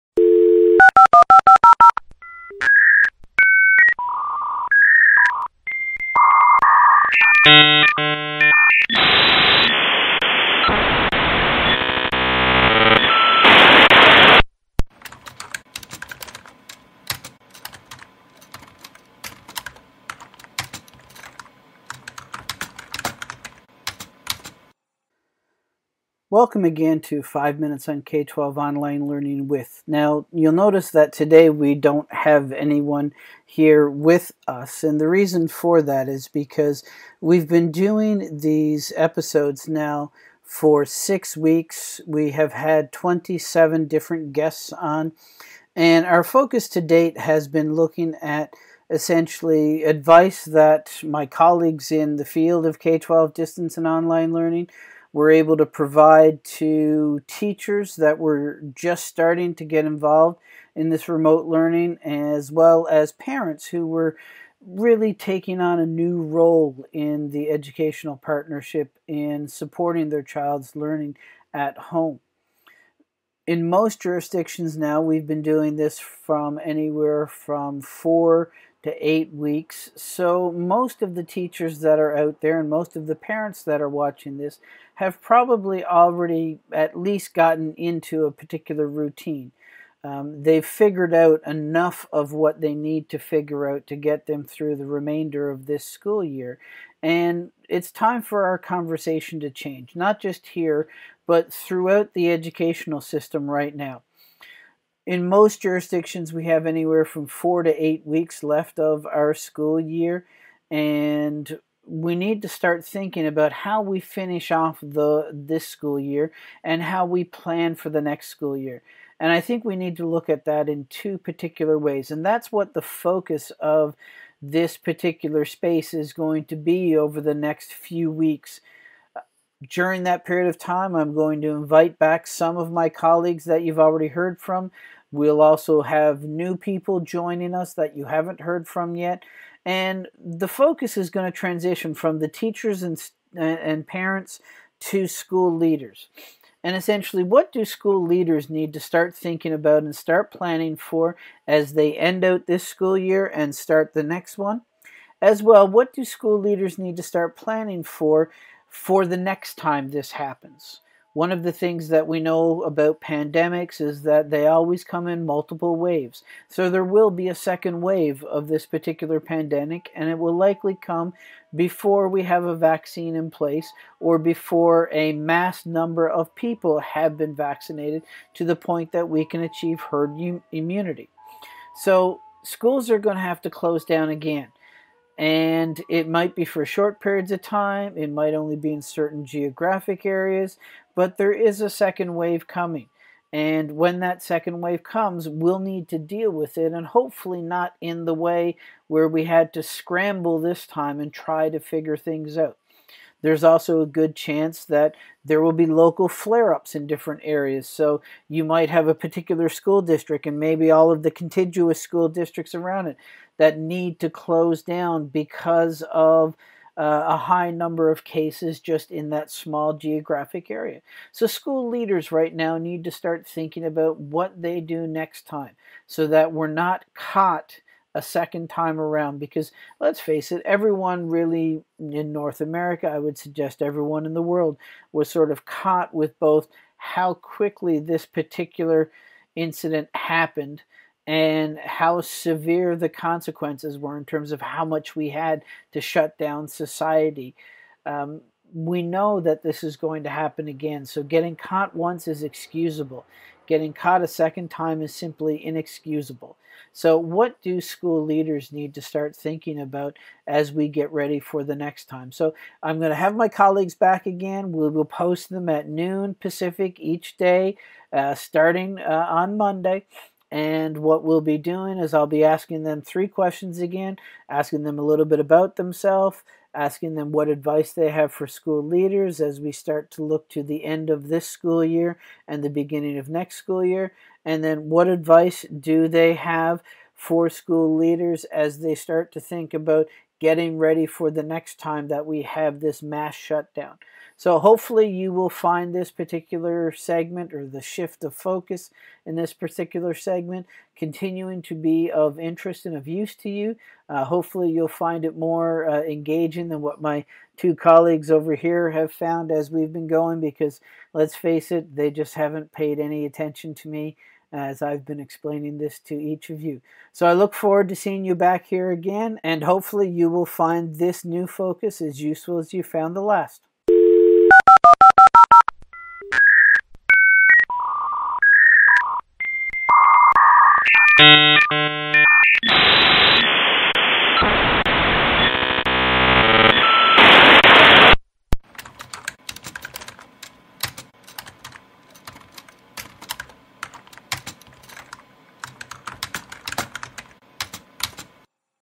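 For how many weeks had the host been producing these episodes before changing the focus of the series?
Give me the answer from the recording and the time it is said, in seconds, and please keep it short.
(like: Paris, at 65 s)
6, at 40 s.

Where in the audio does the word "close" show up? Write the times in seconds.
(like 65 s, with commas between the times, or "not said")
183 s, 214 s.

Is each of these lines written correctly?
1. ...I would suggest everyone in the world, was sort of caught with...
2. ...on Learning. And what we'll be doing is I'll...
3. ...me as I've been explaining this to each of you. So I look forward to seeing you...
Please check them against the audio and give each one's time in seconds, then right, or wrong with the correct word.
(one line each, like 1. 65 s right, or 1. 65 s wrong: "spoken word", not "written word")
1. 232 s right
2. 269 s wrong: "Monday", not "Learning"
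3. 313 s right.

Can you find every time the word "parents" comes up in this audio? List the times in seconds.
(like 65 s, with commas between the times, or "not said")
63 s, 83 s, 143 s.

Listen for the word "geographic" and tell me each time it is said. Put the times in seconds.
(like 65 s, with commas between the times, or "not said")
189 s, 219 s.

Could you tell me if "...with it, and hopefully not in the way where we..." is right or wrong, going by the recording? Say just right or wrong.
right.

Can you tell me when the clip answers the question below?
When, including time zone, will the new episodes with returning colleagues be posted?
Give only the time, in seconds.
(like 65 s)
265 s.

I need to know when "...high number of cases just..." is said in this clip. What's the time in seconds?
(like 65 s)
217 s.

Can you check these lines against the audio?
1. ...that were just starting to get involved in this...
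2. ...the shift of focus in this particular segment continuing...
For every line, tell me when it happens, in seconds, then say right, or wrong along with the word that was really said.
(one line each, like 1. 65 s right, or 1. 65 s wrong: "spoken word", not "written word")
1. 57 s right
2. 297 s right.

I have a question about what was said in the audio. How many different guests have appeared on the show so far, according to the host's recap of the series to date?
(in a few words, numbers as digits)
27.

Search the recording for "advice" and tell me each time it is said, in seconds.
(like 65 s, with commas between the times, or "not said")
49 s, 277 s, 284 s.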